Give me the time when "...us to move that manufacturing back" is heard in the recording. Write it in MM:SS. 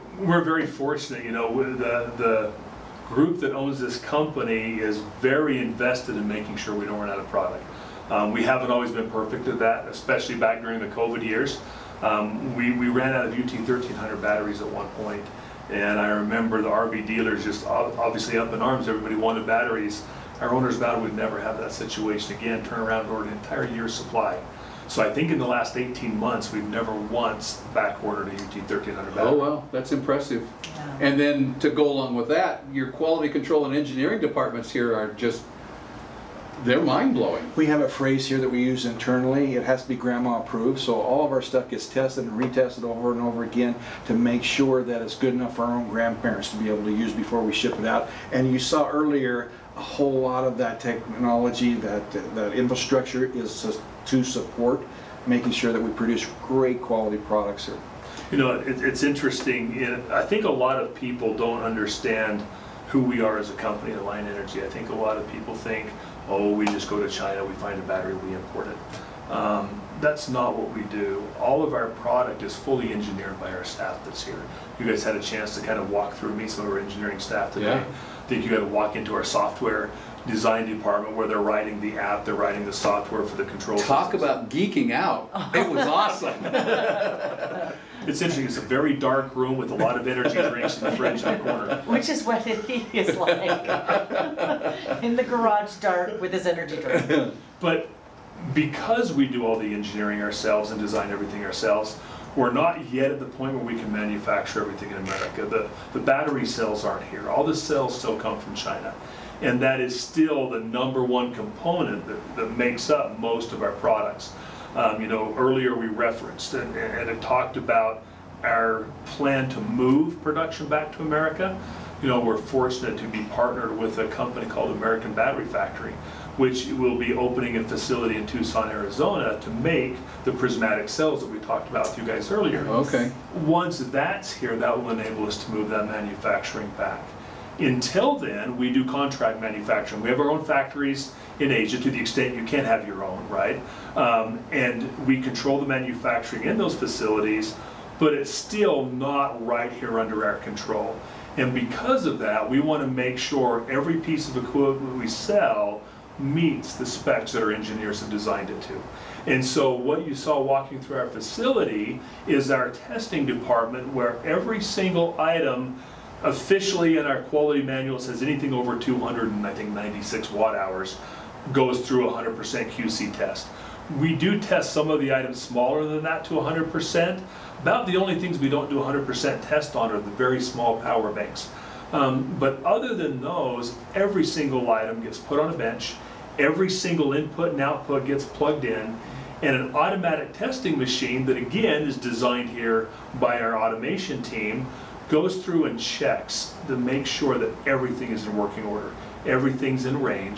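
02:15.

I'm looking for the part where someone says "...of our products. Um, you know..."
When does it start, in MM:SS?
01:53.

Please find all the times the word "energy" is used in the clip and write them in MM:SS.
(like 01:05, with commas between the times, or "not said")
01:04, 01:30, 01:36.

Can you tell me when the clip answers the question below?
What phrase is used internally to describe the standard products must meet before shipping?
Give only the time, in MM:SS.
00:39.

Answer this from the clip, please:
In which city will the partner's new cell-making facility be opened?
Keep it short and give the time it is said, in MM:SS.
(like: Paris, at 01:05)
Tucson, at 02:08.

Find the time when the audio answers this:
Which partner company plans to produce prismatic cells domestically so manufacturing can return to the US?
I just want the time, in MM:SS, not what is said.
02:04.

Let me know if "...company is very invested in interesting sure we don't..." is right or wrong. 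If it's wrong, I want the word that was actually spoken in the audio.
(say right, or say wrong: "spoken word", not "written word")
wrong: "making", not "interesting".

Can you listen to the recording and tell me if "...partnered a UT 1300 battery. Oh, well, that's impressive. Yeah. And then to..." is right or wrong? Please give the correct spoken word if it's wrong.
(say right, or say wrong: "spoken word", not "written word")
wrong: "backordered", not "partnered".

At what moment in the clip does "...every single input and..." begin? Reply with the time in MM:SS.
03:06.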